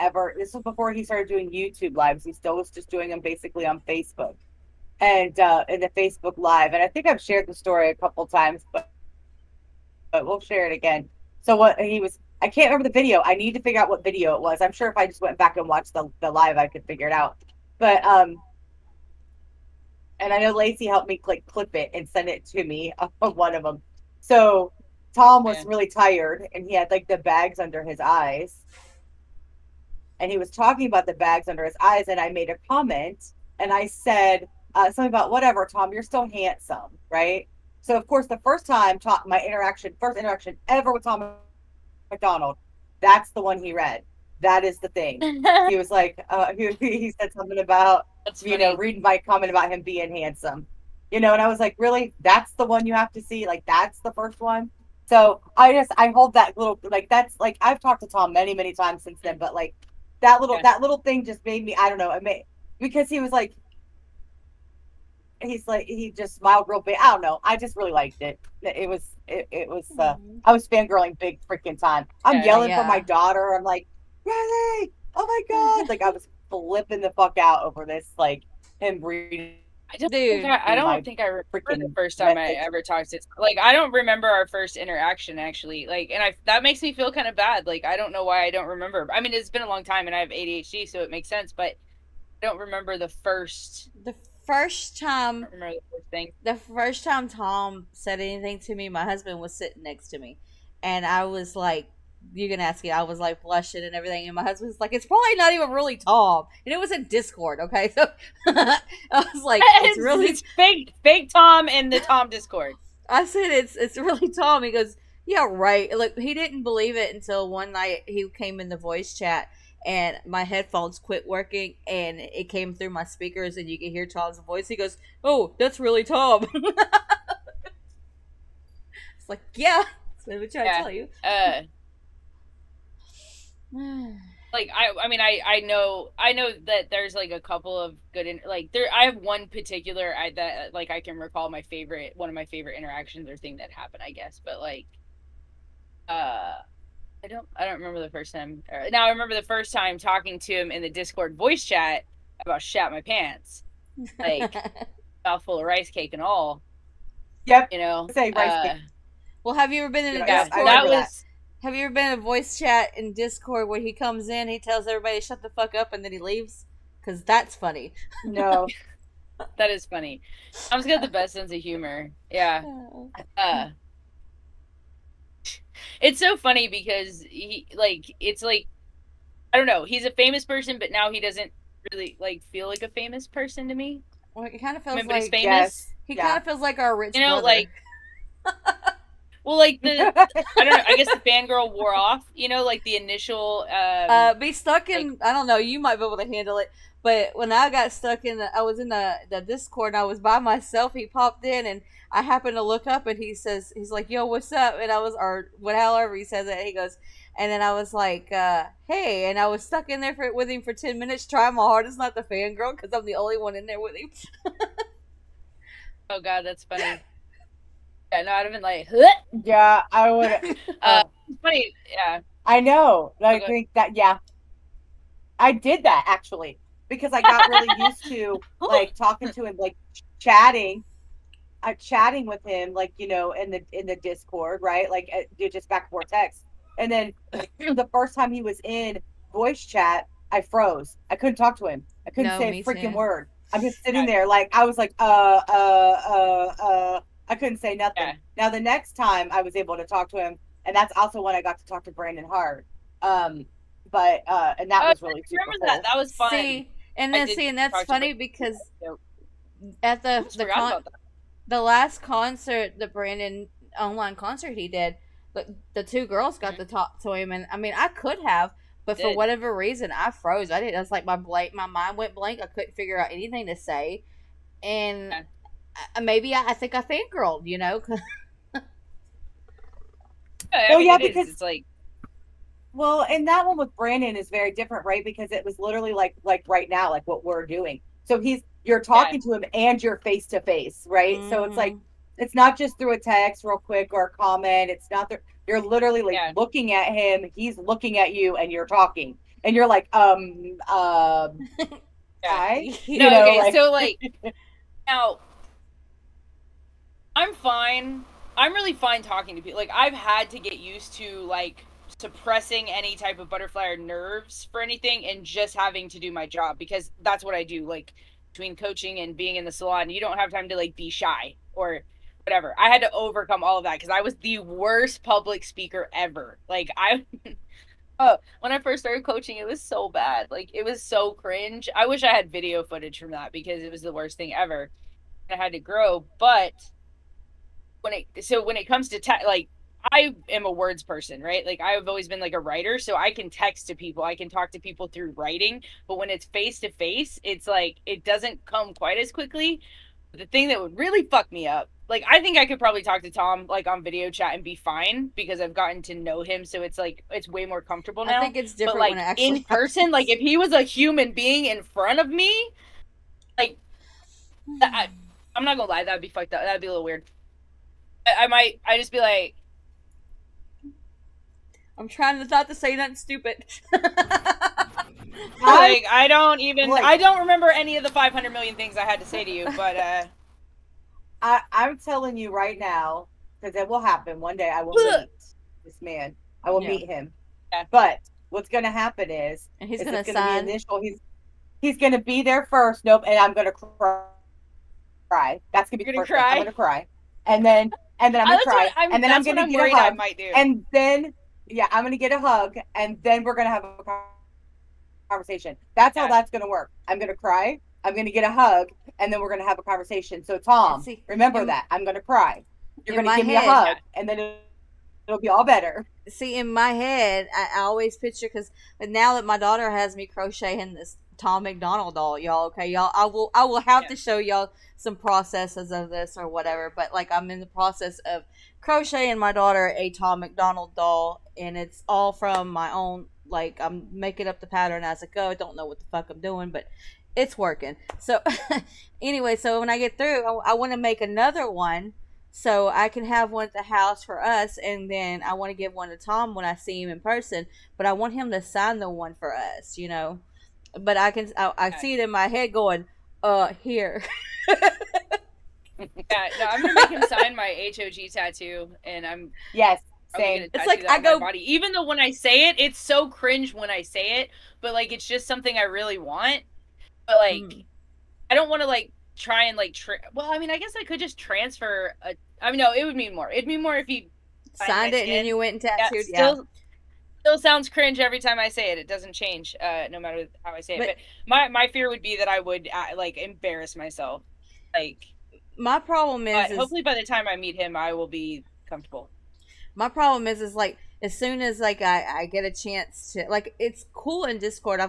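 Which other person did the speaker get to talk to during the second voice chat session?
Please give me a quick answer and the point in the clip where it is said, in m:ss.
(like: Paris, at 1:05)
Brandon Hart, at 4:11.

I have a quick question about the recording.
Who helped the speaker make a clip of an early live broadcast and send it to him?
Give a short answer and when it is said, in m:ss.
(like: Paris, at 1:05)
Lacey, at 0:20.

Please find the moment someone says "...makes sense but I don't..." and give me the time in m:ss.
1:31.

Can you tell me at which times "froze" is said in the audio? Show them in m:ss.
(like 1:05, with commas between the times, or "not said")
4:00, 4:30.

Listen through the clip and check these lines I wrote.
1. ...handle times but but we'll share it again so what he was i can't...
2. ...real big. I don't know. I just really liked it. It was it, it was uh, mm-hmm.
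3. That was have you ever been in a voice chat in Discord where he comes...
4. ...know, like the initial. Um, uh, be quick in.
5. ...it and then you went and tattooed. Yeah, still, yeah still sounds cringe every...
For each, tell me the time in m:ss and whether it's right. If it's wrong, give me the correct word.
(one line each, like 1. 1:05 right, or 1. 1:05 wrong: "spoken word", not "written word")
1. 0:07 wrong: "couple", not "handle"
2. 1:06 right
3. 2:40 right
4. 3:12 wrong: "stuck", not "quick"
5. 7:54 right.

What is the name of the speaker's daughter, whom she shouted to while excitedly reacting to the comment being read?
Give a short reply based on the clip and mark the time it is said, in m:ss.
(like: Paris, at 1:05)
Riley, at 1:14.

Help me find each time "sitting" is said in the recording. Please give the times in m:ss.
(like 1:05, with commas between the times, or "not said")
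1:39, 4:03.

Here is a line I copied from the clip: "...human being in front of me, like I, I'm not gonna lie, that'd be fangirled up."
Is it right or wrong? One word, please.
wrong.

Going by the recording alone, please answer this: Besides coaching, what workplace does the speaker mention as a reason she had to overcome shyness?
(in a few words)
The salon.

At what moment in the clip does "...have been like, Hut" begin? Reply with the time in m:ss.
3:38.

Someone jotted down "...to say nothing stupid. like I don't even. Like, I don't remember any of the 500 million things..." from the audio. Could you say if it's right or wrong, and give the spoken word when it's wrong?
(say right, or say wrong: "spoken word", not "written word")
right.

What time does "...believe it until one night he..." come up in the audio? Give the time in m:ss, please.
1:56.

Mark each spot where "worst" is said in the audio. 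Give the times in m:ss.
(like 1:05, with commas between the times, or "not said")
5:24, 5:33.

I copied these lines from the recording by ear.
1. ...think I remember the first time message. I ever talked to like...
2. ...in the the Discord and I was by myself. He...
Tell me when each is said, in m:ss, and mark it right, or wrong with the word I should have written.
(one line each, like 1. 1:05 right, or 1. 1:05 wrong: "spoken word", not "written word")
1. 1:21 right
2. 3:18 right.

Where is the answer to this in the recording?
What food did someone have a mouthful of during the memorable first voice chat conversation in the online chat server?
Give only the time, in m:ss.
2:35.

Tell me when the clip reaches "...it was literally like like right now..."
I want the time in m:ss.
4:45.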